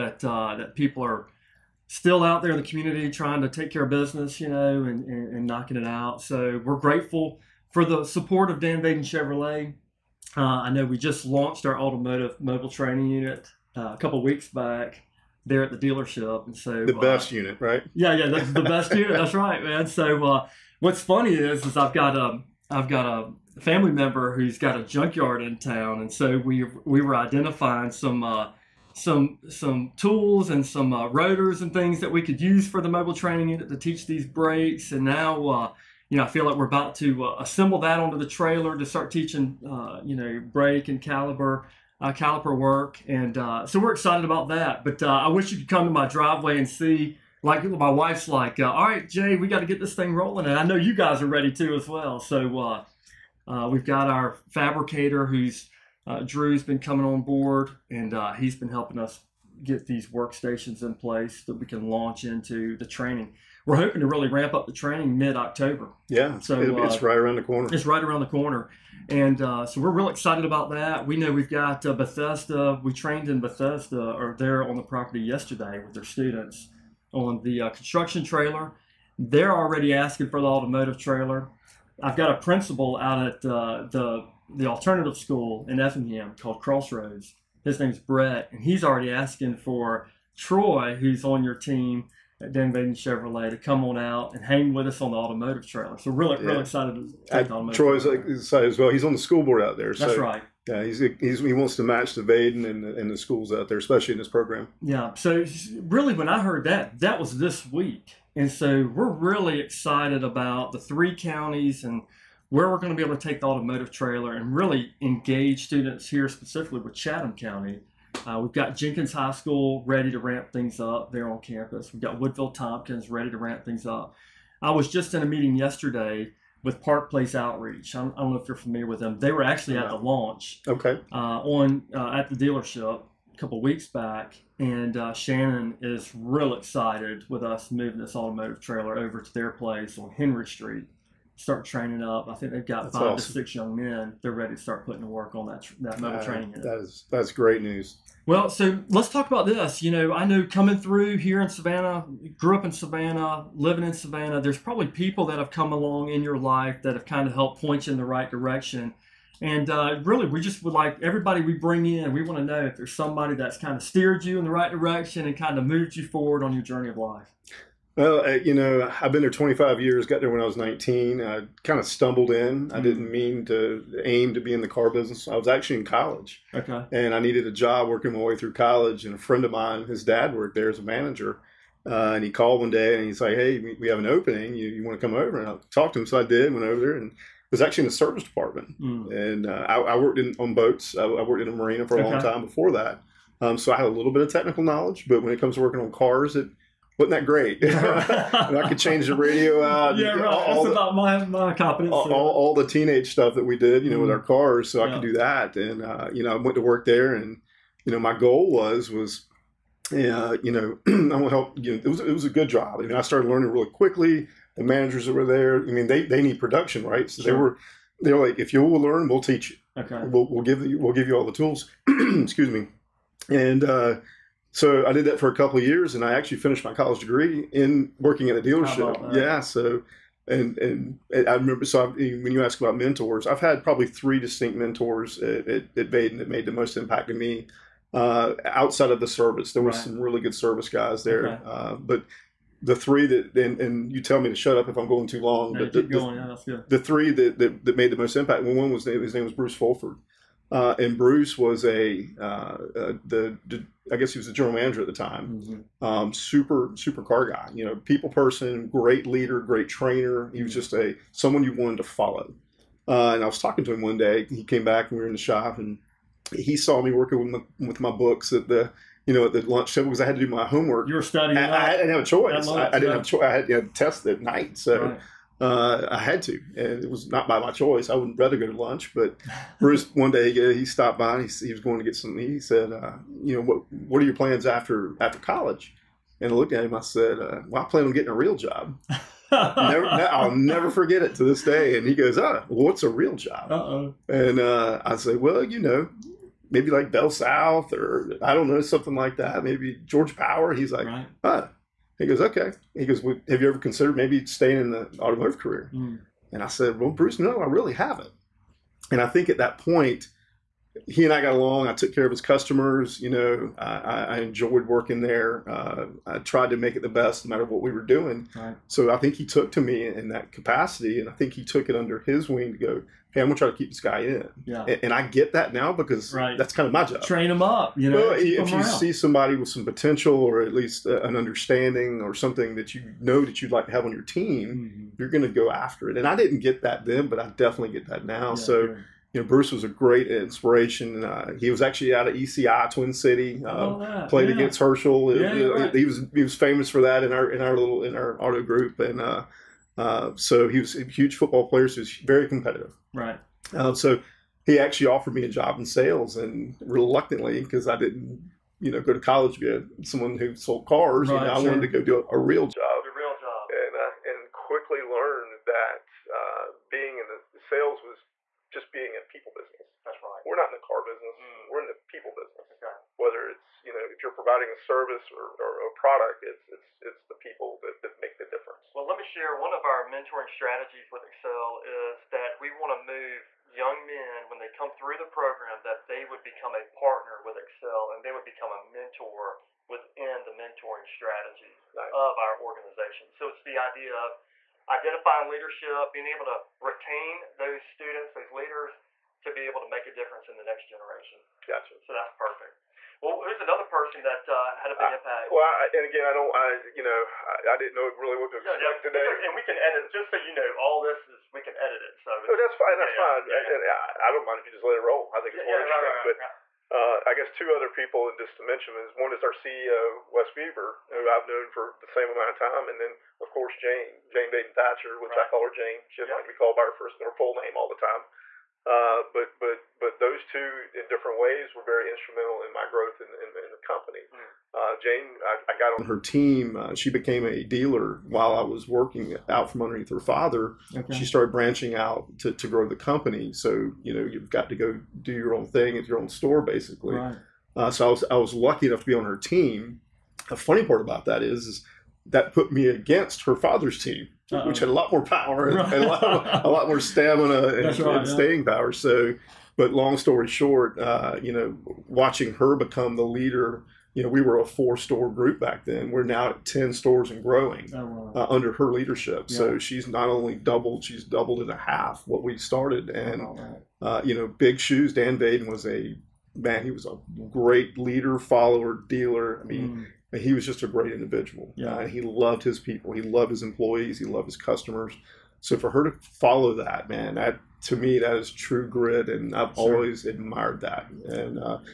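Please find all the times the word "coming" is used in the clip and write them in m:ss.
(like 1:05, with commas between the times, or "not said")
0:56, 2:30.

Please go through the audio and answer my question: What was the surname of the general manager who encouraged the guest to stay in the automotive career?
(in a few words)
Fulford.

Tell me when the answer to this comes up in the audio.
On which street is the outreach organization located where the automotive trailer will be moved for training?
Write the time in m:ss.
2:20.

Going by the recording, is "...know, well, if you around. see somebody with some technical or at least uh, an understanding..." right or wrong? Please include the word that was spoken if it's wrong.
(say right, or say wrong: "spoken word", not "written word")
wrong: "potential", not "technical".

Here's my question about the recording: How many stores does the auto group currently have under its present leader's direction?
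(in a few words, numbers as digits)
10.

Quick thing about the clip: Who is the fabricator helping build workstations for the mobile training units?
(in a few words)
Drew.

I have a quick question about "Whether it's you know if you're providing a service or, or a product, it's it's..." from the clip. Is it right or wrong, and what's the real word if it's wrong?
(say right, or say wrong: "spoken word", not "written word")
right.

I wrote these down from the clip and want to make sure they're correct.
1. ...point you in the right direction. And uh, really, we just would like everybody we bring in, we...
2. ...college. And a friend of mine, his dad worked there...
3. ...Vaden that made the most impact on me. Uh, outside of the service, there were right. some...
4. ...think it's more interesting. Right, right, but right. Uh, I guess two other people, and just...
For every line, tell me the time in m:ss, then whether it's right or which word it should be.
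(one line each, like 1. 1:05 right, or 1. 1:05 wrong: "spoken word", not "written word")
1. 2:37 right
2. 2:58 right
3. 3:55 right
4. 6:55 right.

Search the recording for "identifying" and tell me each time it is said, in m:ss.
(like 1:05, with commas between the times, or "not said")
0:27, 6:34.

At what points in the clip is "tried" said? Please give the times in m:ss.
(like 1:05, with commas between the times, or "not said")
5:16.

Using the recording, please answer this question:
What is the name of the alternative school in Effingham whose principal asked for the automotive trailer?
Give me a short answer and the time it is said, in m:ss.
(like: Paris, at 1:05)
Crossroads, at 1:26.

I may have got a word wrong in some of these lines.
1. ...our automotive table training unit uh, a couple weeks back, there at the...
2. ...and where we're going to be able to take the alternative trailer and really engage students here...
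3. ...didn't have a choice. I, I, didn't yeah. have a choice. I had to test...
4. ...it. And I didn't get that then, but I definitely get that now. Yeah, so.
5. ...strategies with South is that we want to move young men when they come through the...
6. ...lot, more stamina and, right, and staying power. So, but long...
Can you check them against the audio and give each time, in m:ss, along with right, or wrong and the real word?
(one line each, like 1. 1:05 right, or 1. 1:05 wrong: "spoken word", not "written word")
1. 0:11 wrong: "mobile", not "table"
2. 1:51 wrong: "automotive", not "alternative"
3. 4:31 right
4. 5:35 right
5. 6:20 wrong: "Xcel", not "South"
6. 7:36 right.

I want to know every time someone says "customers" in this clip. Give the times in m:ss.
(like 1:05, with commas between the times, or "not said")
5:12, 8:04.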